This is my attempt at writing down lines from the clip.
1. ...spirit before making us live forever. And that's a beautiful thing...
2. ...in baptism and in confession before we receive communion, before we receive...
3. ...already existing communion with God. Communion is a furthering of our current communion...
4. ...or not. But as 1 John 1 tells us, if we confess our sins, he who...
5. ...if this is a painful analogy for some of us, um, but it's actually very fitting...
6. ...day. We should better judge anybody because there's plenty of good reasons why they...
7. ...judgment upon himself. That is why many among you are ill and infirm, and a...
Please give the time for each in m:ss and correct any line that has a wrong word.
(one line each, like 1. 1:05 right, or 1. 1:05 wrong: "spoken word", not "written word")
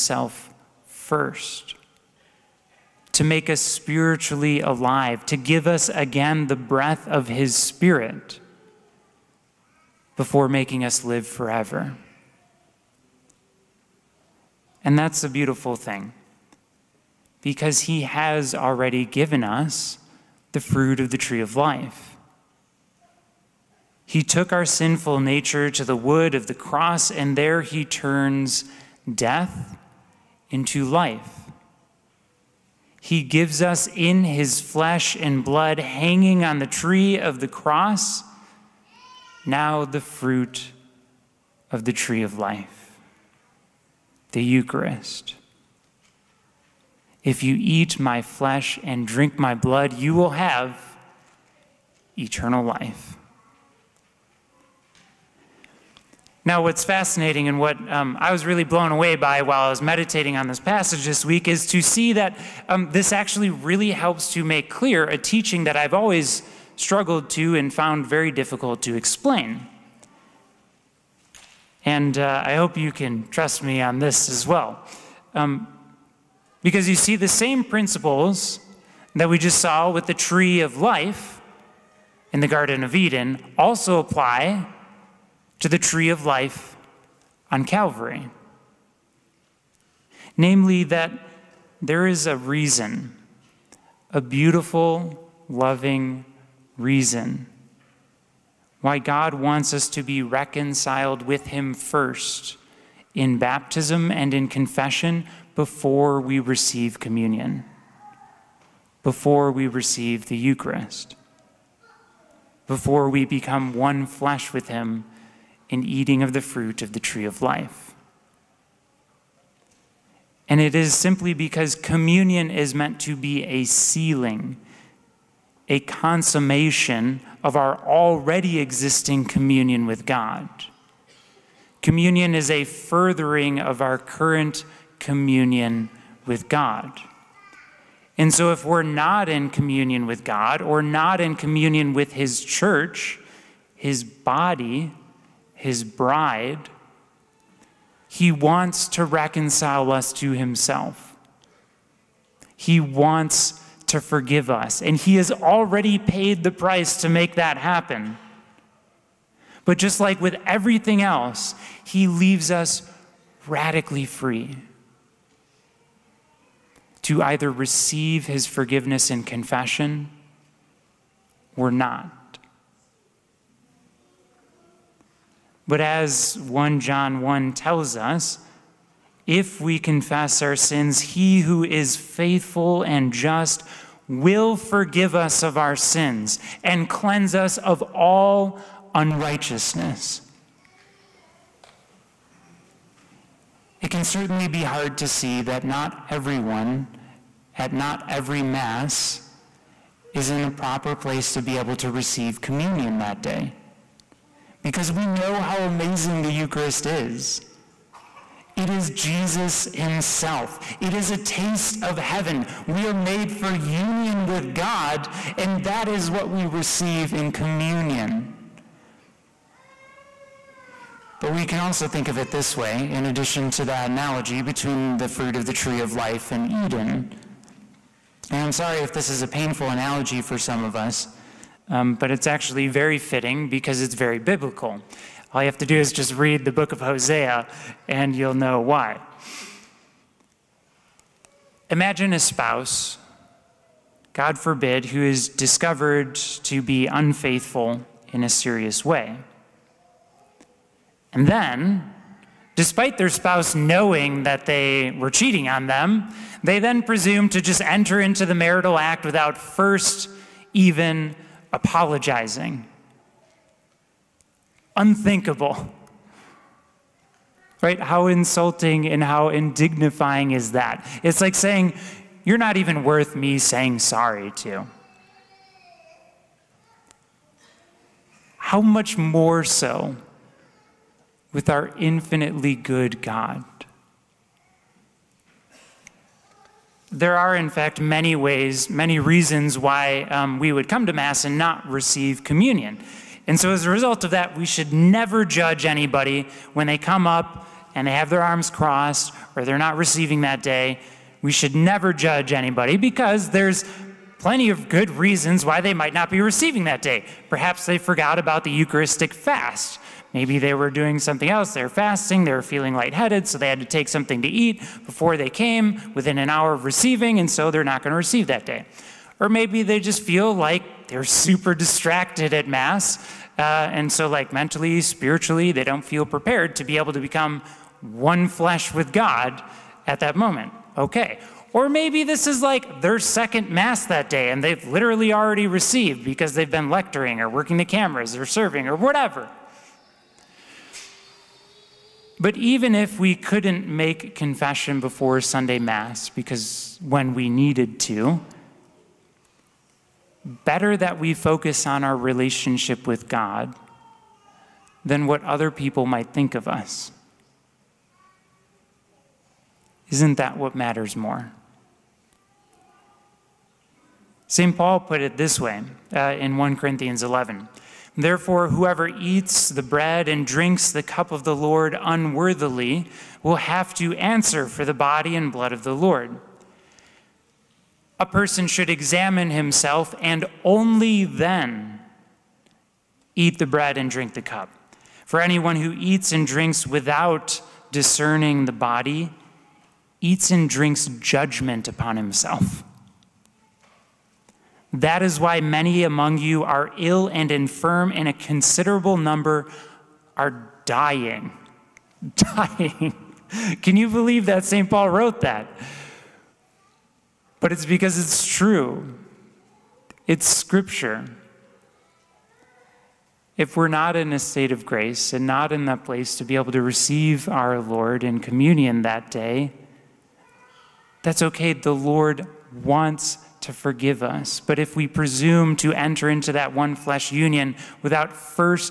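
1. 0:07 right
2. 1:43 right
3. 2:07 right
4. 2:51 right
5. 3:48 right
6. 5:00 wrong: "never", not "better"
7. 6:30 right.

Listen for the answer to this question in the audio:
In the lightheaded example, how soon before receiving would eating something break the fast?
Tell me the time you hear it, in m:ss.
5:16.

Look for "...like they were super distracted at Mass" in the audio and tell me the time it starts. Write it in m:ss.
5:20.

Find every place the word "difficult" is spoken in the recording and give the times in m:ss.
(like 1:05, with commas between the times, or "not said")
1:08.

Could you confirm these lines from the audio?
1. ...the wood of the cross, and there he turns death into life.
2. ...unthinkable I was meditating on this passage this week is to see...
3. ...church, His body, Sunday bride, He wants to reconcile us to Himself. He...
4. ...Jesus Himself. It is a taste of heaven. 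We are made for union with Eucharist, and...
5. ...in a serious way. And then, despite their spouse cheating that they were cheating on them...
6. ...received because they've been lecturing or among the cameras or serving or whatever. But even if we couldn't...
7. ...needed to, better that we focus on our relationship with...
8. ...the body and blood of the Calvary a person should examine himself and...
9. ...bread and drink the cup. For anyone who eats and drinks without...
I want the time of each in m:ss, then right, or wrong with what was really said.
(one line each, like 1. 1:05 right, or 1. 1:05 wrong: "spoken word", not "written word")
1. 0:25 right
2. 0:59 wrong: "while", not "unthinkable"
3. 2:22 wrong: "His", not "Sunday"
4. 3:28 wrong: "God", not "Eucharist"
5. 4:08 wrong: "knowing", not "cheating"
6. 5:35 wrong: "working", not "among"
7. 5:47 right
8. 6:14 wrong: "Lord", not "Calvary"
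9. 6:23 right.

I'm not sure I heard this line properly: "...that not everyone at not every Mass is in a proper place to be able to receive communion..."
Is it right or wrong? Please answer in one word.
right.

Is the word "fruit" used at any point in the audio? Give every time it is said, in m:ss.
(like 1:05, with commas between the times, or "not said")
0:20, 0:39, 1:56, 3:45.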